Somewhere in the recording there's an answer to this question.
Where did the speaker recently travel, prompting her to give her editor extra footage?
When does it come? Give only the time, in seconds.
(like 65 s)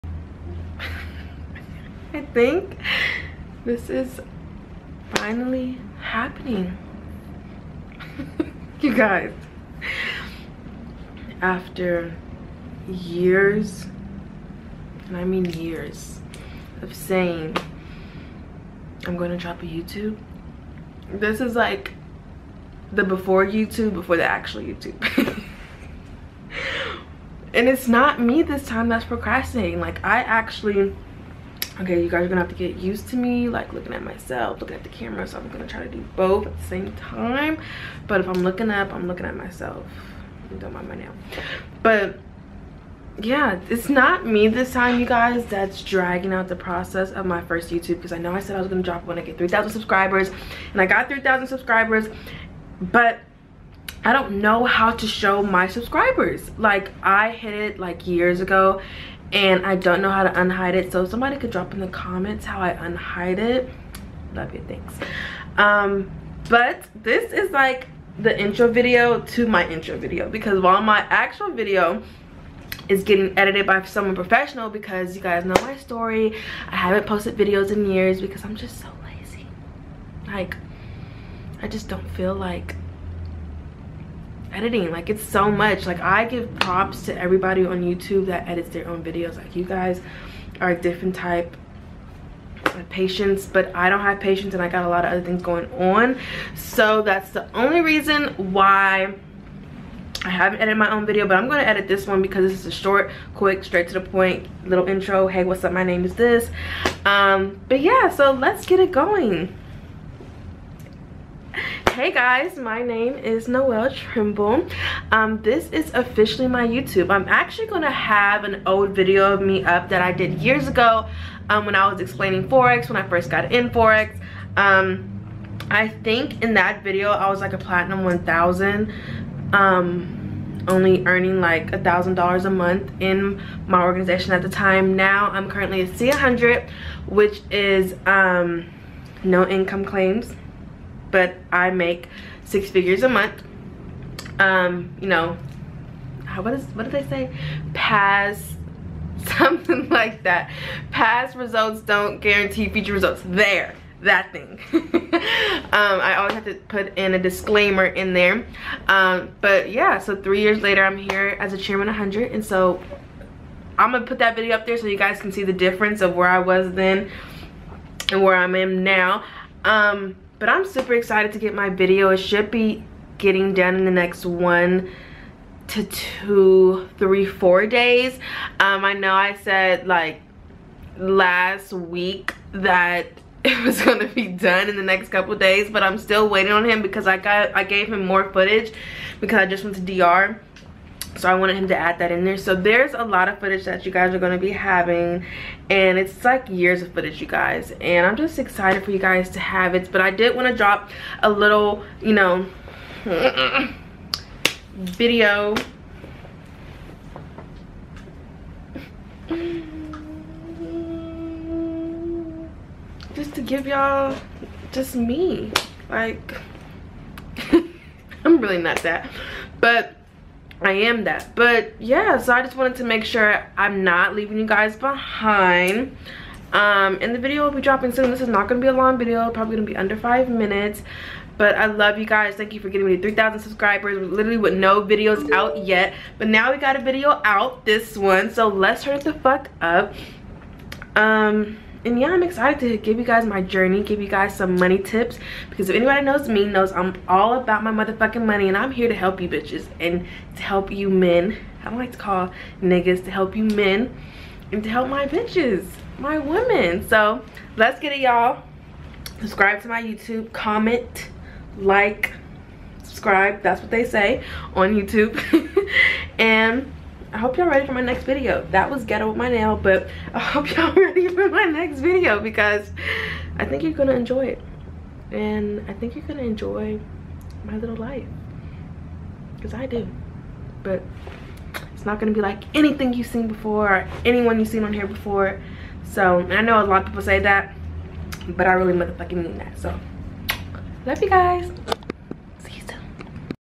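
189 s.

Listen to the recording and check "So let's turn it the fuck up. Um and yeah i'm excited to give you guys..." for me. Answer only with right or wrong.
right.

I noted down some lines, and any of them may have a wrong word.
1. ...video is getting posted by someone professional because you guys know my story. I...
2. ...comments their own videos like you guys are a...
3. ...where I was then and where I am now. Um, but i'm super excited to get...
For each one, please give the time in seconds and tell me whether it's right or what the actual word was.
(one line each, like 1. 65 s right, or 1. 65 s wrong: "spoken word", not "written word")
1. 71 s wrong: "edited", not "posted"
2. 88 s wrong: "edits", not "comments"
3. 166 s right.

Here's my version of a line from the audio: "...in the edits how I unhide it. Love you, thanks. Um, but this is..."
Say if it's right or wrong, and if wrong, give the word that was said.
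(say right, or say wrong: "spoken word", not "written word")
wrong: "comments", not "edits".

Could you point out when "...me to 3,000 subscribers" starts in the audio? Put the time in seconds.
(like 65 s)
232 s.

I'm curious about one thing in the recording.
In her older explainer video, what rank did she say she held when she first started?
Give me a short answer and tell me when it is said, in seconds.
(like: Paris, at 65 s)
platinum 1000, at 127 s.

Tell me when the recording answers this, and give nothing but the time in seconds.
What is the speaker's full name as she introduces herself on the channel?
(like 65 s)
113 s.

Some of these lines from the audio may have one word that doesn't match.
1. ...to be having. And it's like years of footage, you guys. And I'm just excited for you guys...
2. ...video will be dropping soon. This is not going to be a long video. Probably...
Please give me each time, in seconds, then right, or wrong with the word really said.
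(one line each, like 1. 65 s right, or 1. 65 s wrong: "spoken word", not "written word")
1. 194 s right
2. 227 s right.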